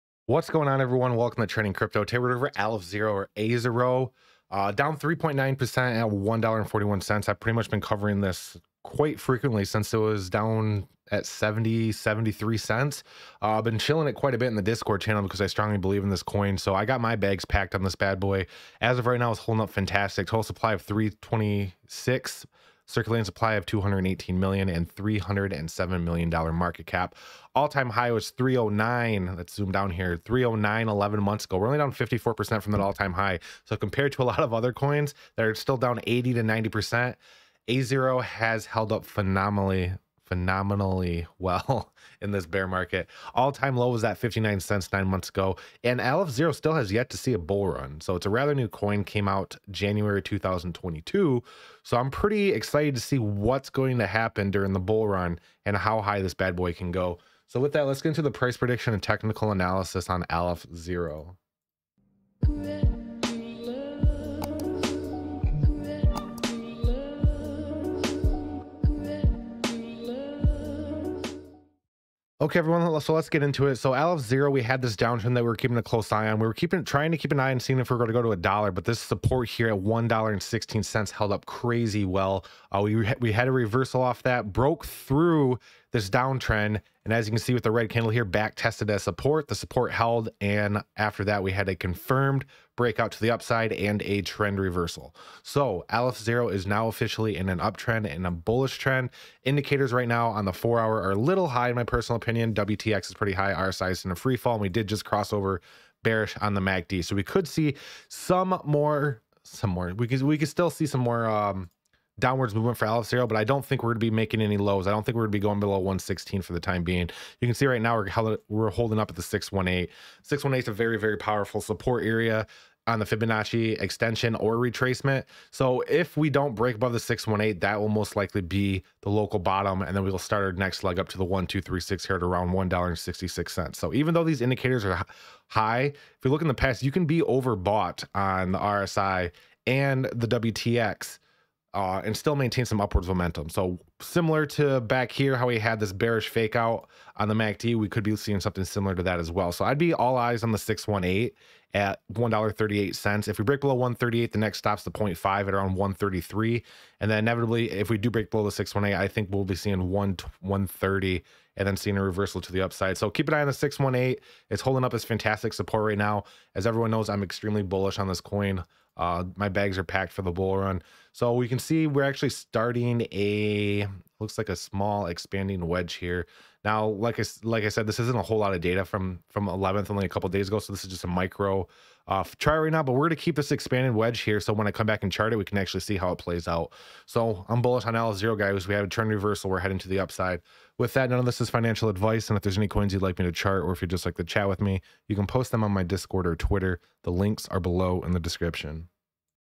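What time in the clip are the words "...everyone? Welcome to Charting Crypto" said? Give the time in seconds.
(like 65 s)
0 s.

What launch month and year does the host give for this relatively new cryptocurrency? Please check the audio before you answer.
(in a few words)
January 2022.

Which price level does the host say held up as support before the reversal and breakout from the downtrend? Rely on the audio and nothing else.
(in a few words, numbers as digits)
$1.16.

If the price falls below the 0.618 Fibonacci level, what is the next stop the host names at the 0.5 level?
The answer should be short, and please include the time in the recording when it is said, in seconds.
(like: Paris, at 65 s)
$1.33, at 155 s.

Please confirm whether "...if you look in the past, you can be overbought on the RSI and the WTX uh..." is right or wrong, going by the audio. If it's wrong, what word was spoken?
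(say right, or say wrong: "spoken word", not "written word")
right.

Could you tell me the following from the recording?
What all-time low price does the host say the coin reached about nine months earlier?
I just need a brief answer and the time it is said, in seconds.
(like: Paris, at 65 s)
59 cents, at 44 s.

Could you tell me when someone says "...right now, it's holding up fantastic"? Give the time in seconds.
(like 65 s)
19 s.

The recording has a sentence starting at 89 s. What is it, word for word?
The support held, and after that, we had a confirmed breakout to the upside and a trend reversal.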